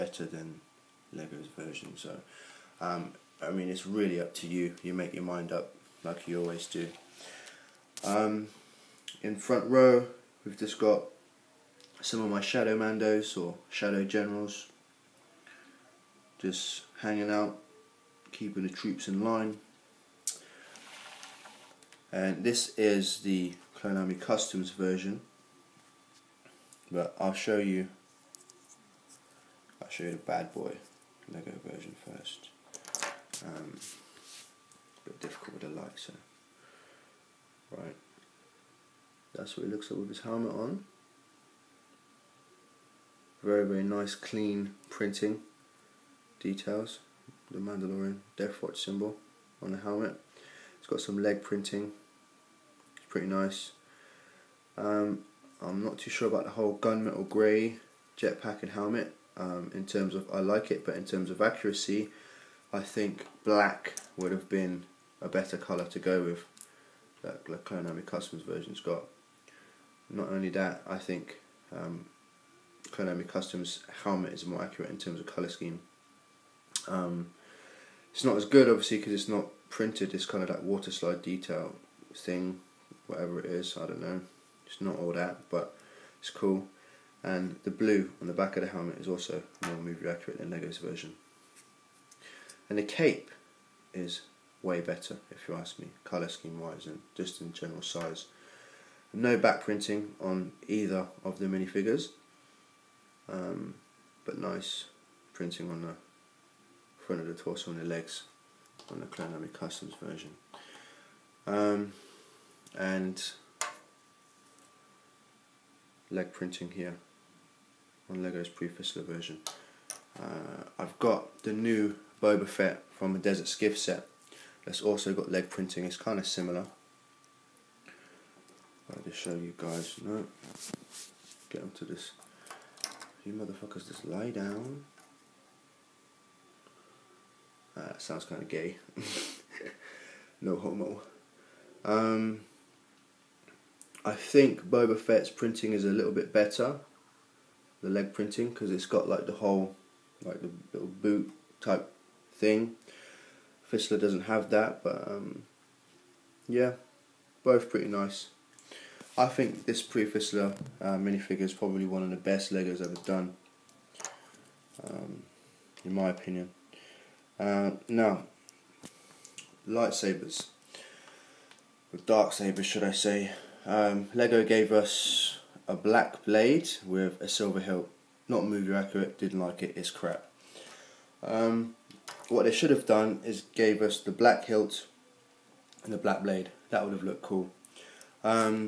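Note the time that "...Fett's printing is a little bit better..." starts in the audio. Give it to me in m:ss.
2:24.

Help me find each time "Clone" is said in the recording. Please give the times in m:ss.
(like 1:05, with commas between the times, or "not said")
0:23, 1:07, 1:12, 1:49.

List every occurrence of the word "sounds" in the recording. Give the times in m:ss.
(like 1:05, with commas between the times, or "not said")
2:17.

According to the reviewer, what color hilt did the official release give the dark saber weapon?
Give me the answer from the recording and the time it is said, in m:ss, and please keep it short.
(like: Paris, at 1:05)
Silver, at 2:57.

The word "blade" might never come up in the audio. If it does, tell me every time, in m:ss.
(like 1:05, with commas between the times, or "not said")
2:56, 3:06.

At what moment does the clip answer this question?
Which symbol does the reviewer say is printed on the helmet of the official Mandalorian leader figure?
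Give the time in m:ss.
0:47.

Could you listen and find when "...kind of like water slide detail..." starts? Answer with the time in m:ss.
1:20.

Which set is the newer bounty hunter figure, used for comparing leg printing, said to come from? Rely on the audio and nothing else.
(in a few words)
Desert Skiff.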